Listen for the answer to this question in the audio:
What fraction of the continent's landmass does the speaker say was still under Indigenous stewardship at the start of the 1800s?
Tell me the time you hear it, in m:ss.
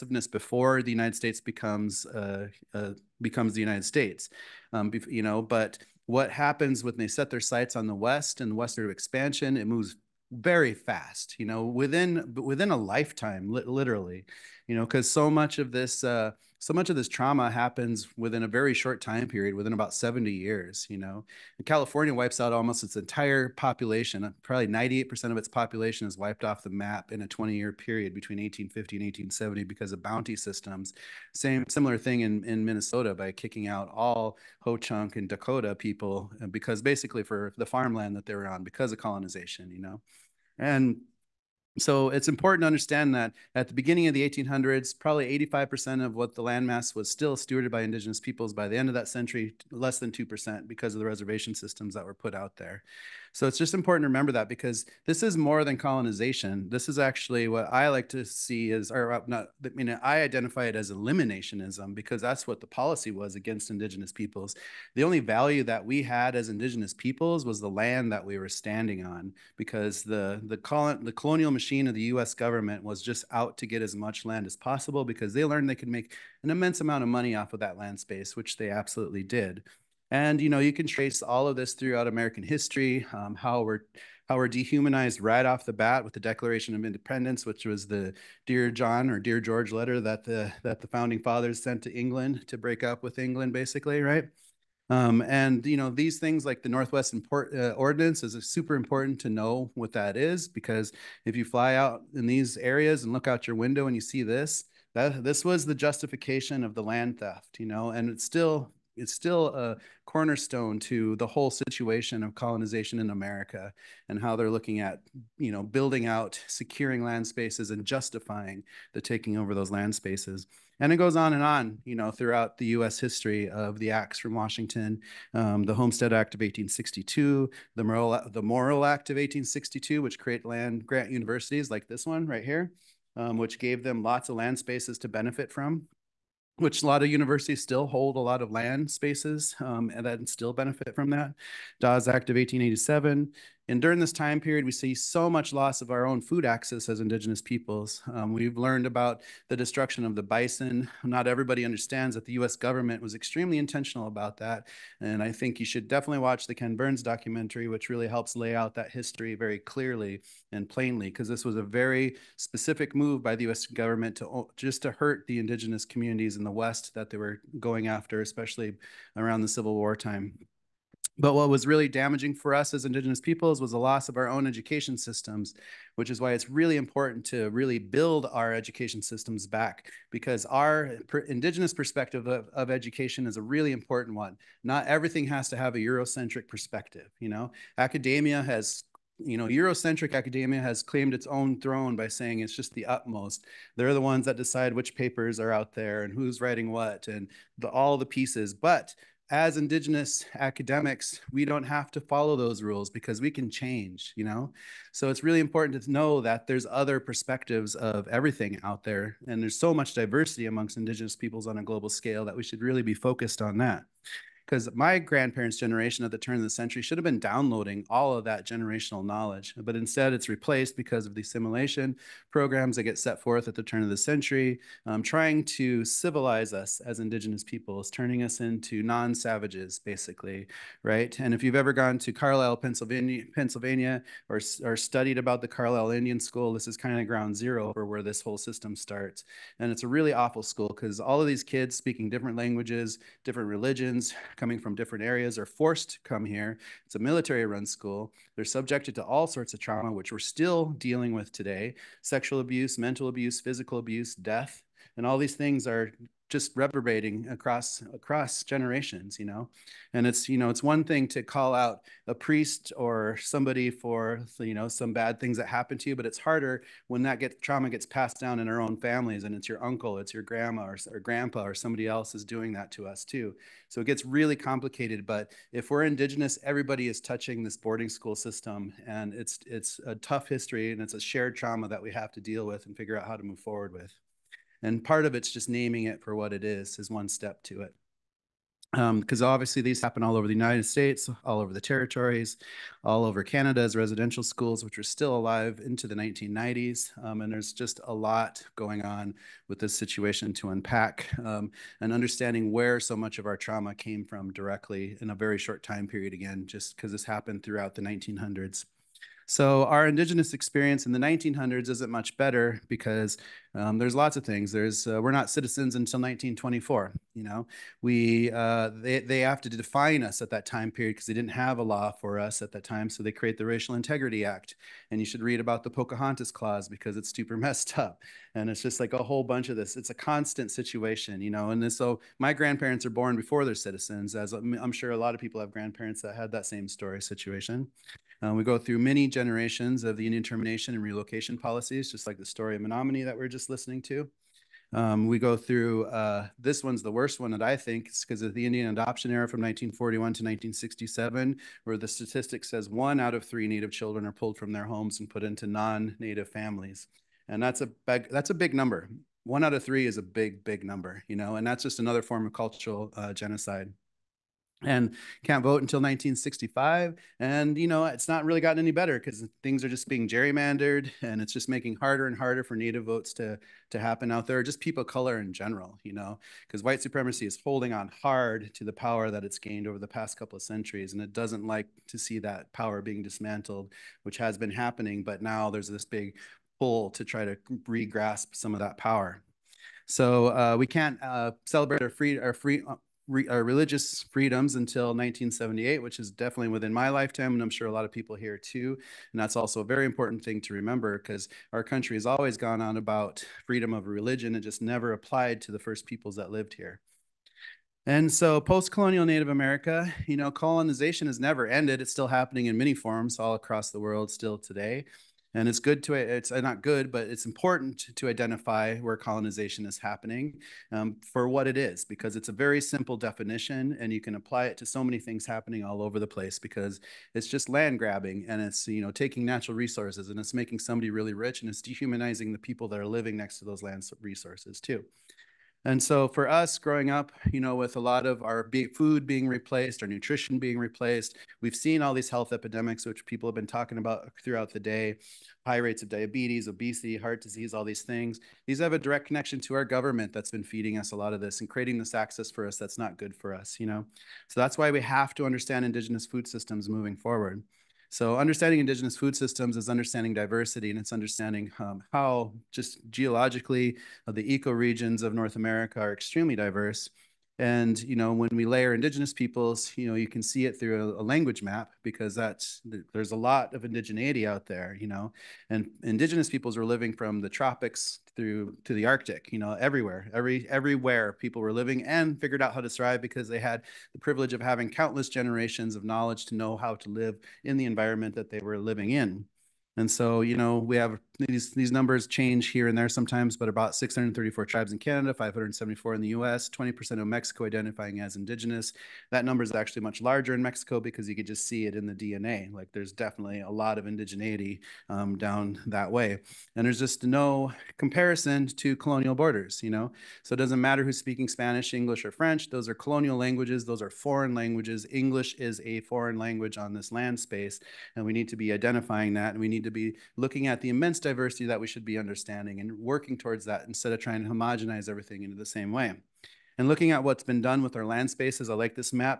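0:45.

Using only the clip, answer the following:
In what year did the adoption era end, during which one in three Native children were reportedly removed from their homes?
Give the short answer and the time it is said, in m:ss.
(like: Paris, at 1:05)
1967, at 5:50.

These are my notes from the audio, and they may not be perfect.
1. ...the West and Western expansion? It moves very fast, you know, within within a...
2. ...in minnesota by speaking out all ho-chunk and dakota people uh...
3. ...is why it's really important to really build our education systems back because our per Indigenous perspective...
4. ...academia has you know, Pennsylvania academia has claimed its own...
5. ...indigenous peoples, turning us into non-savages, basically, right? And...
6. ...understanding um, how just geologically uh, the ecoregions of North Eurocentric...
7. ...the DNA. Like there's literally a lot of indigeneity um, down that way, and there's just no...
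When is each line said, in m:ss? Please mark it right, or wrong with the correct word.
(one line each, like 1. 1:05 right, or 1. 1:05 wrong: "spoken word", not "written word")
1. 0:07 right
2. 0:32 wrong: "kicking", not "speaking"
3. 2:56 right
4. 3:07 wrong: "Eurocentric", not "Pennsylvania"
5. 3:47 right
6. 7:40 wrong: "America", not "Eurocentric"
7. 8:21 wrong: "definitely", not "literally".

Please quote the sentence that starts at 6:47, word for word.
And so post-colonial Native America, you know, colonization has never ended.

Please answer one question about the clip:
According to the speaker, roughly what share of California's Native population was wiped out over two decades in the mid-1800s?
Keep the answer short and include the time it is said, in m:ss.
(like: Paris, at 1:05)
98%, at 0:24.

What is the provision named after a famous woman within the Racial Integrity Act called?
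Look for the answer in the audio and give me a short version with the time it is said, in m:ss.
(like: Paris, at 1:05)
Pocahontas Clause, at 5:25.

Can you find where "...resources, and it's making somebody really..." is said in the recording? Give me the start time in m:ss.
7:09.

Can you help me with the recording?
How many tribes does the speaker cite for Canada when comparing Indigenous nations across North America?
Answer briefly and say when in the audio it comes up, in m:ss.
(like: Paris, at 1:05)
634, at 8:13.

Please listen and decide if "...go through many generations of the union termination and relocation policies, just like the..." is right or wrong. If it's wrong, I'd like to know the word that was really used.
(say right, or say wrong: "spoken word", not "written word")
right.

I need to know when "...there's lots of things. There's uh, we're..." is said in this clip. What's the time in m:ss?
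5:13.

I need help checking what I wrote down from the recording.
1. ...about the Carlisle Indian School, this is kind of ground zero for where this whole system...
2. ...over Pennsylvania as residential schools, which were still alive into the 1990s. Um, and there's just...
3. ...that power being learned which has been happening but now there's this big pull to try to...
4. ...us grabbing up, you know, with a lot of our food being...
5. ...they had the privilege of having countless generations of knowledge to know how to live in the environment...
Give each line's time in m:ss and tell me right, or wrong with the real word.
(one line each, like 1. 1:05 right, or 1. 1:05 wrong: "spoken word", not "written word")
1. 3:55 right
2. 4:53 wrong: "Canada", not "Pennsylvania"
3. 6:22 wrong: "dismantled", not "learned"
4. 7:16 wrong: "growing", not "grabbing"
5. 8:03 right.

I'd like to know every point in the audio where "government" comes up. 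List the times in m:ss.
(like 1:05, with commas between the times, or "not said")
1:12, 2:32, 2:43, 7:29.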